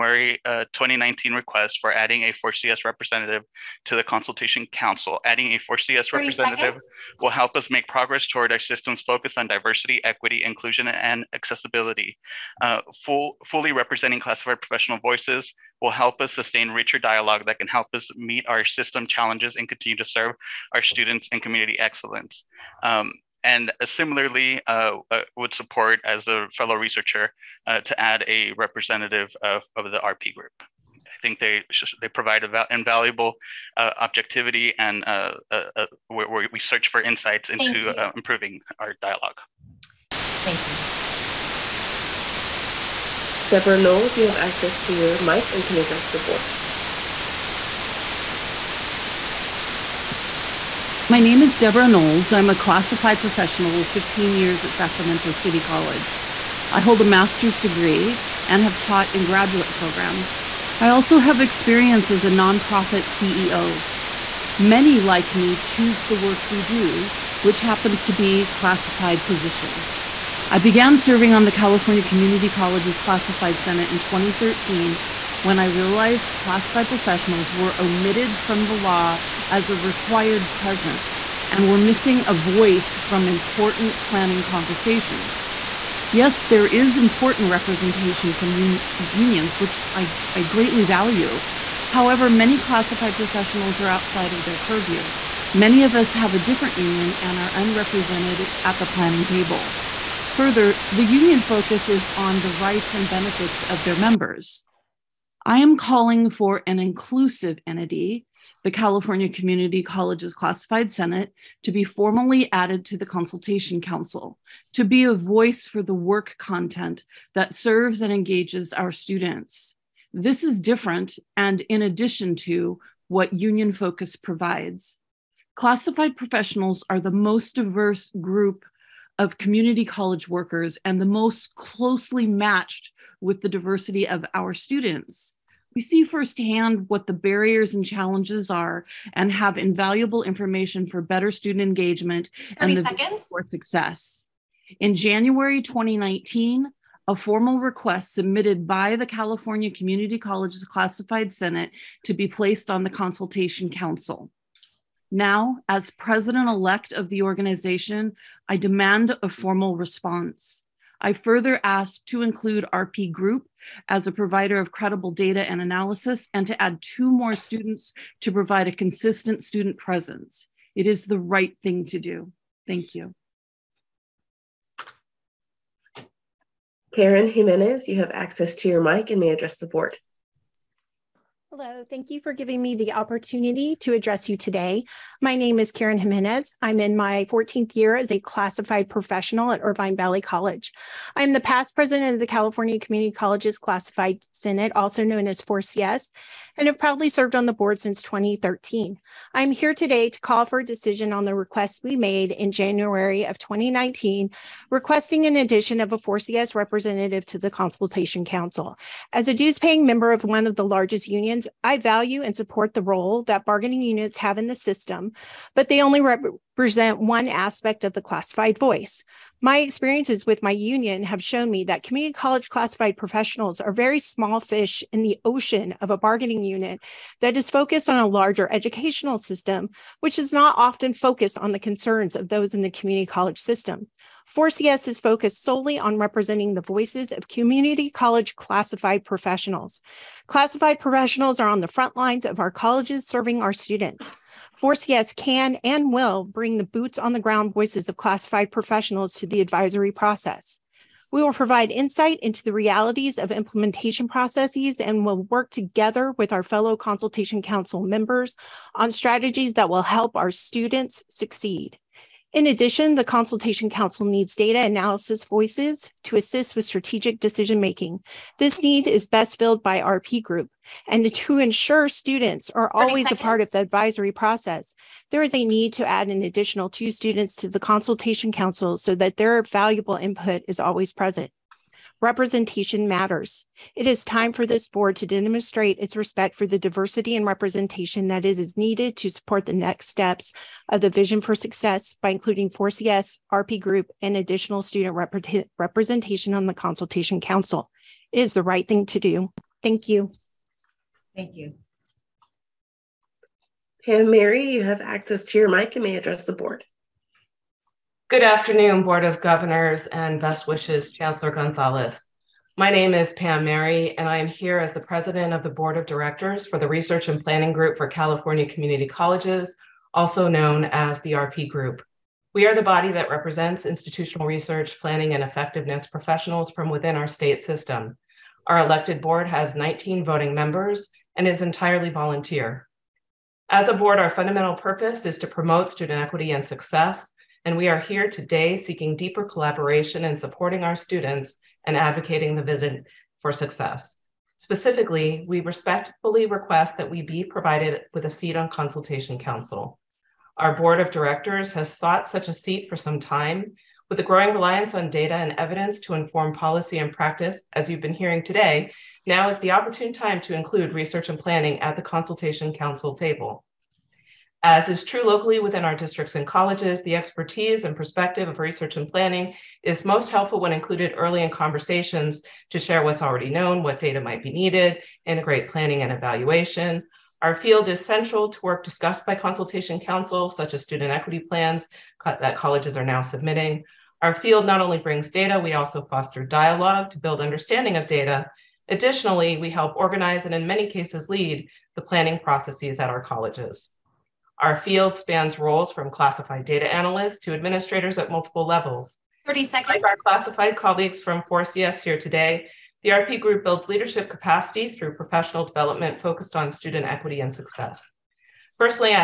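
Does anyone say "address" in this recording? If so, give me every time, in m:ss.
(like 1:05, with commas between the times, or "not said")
0:45, 2:59, 3:03, 5:05.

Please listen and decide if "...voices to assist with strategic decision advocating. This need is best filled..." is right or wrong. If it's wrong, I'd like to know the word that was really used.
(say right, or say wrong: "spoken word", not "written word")
wrong: "making", not "advocating".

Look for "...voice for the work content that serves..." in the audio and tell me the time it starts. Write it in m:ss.
1:55.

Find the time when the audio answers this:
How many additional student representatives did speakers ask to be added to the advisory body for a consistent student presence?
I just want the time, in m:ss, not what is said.
2:46.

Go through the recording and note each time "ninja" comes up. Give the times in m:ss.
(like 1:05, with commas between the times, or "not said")
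not said.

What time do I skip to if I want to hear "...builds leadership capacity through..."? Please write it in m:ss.
6:43.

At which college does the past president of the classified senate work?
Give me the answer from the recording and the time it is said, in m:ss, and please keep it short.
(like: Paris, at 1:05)
Irvine Valley College, at 3:09.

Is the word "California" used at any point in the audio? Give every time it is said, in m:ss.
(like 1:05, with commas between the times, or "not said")
1:11, 1:48, 2:29, 3:12, 5:17.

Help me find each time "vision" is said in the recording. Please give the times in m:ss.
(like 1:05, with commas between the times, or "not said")
4:50, 5:42.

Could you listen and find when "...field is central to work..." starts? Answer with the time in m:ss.
6:17.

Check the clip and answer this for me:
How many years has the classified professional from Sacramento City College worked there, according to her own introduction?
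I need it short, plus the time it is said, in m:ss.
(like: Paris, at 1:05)
15, at 0:53.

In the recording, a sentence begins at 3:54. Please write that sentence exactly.
4CS is focused solely on representing the voices of community college classified professionals.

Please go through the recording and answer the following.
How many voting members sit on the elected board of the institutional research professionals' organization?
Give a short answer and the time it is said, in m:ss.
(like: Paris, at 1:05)
19, at 5:29.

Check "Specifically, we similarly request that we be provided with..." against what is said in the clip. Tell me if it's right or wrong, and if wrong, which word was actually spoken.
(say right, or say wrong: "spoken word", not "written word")
wrong: "respectfully", not "similarly".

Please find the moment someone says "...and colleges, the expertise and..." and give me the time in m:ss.
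6:06.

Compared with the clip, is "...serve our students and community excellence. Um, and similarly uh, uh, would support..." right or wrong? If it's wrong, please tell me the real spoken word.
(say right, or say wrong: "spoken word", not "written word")
right.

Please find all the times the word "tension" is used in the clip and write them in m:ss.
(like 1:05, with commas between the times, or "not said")
not said.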